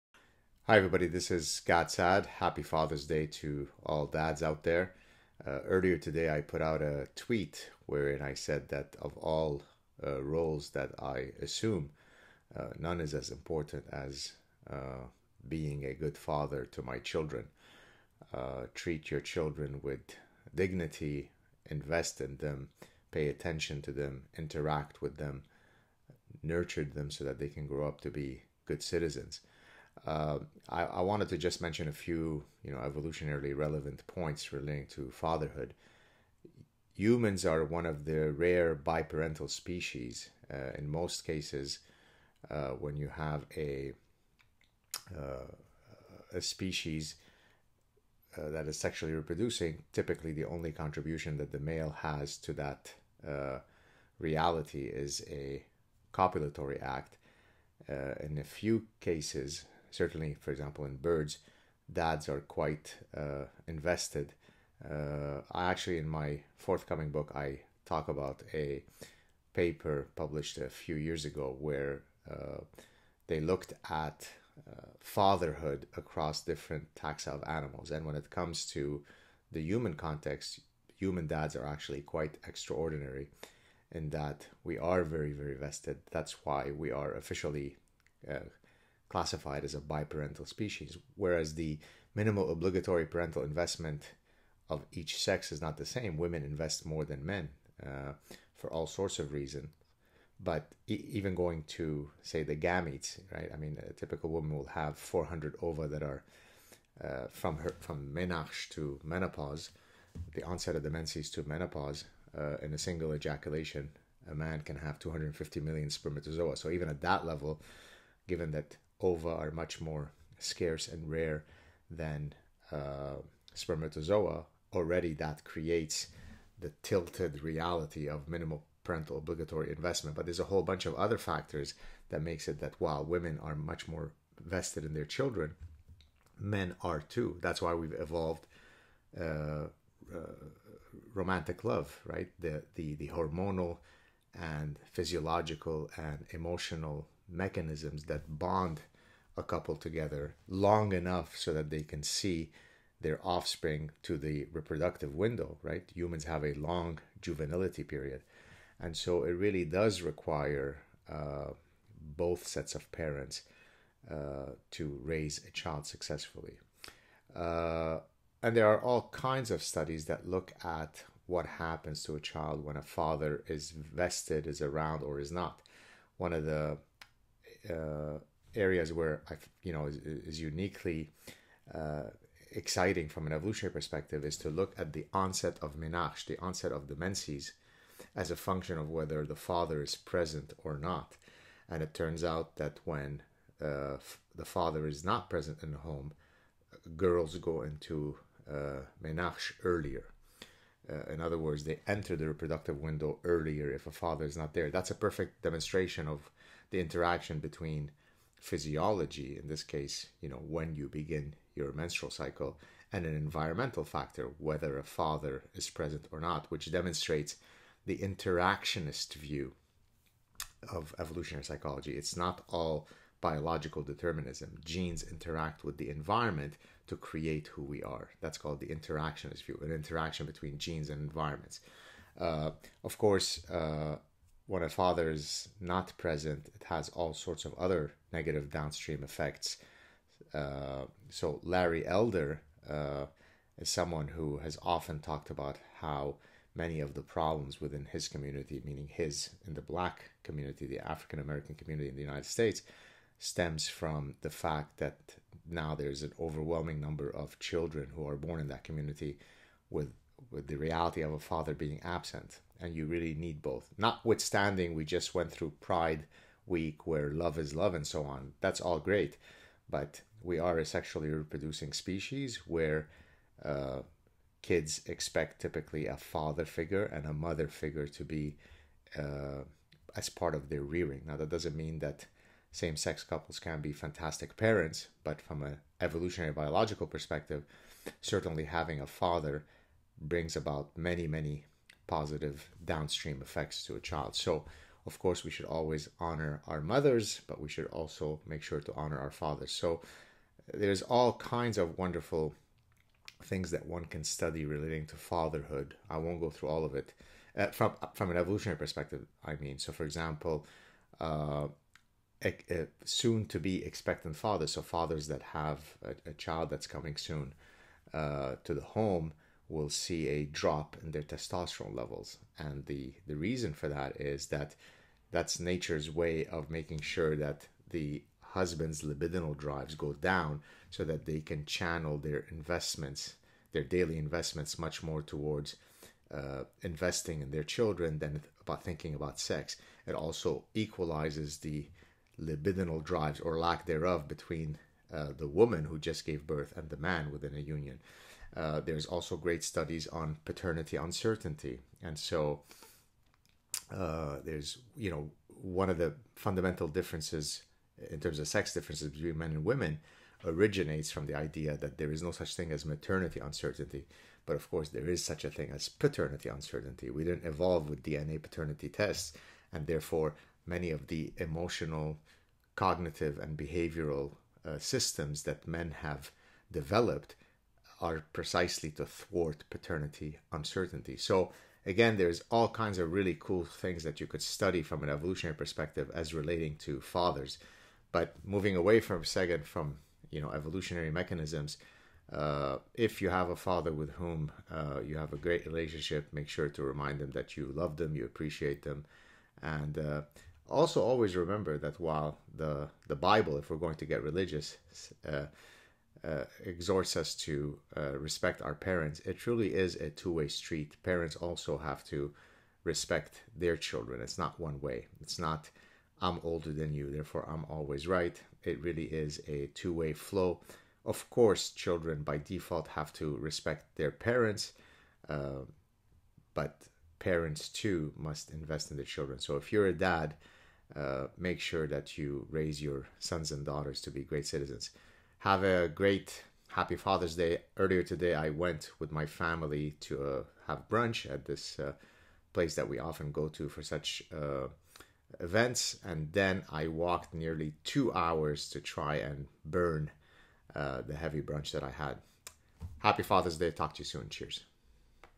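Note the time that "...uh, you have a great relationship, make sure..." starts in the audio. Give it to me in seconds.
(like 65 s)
394 s.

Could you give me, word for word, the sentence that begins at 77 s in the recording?
And when it comes to the human context, human dads are actually quite extraordinary in that we are very, very vested.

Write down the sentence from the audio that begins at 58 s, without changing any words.
in a few cases, certainly, for example, in birds, dads are quite uh, invested.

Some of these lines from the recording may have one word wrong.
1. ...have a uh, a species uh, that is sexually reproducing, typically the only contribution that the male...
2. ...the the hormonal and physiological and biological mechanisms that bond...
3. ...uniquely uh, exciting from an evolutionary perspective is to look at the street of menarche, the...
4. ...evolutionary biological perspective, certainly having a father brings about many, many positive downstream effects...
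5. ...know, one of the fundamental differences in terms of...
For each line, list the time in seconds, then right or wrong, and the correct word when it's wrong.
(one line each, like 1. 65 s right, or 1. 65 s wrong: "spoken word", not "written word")
1. 43 s right
2. 142 s wrong: "emotional", not "biological"
3. 180 s wrong: "onset", not "street"
4. 285 s right
5. 354 s right.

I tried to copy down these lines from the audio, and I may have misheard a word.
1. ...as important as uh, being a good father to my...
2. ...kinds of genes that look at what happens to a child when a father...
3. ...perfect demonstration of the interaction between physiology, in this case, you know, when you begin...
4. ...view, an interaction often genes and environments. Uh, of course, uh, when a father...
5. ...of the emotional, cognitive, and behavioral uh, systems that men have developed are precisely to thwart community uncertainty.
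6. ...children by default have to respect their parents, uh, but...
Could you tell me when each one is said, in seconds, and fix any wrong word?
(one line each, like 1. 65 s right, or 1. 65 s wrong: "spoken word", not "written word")
1. 13 s right
2. 169 s wrong: "studies", not "genes"
3. 204 s right
4. 229 s wrong: "between", not "often"
5. 370 s wrong: "paternity", not "community"
6. 421 s right.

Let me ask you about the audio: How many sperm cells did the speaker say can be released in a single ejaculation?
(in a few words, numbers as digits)
250 million.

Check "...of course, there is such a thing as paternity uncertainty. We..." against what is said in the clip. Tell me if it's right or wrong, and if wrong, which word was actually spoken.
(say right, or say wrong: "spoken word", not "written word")
right.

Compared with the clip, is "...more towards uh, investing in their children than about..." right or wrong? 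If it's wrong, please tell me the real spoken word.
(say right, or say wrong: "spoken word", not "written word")
right.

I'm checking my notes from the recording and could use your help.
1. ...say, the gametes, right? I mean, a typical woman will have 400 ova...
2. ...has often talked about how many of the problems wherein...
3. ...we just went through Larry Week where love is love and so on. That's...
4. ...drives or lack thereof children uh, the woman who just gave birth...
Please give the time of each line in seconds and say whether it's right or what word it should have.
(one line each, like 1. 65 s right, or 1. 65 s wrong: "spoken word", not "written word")
1. 102 s right
2. 244 s wrong: "within", not "wherein"
3. 264 s wrong: "Pride", not "Larry"
4. 342 s wrong: "between", not "children".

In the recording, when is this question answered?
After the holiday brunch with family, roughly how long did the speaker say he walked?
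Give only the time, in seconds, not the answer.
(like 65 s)
447 s.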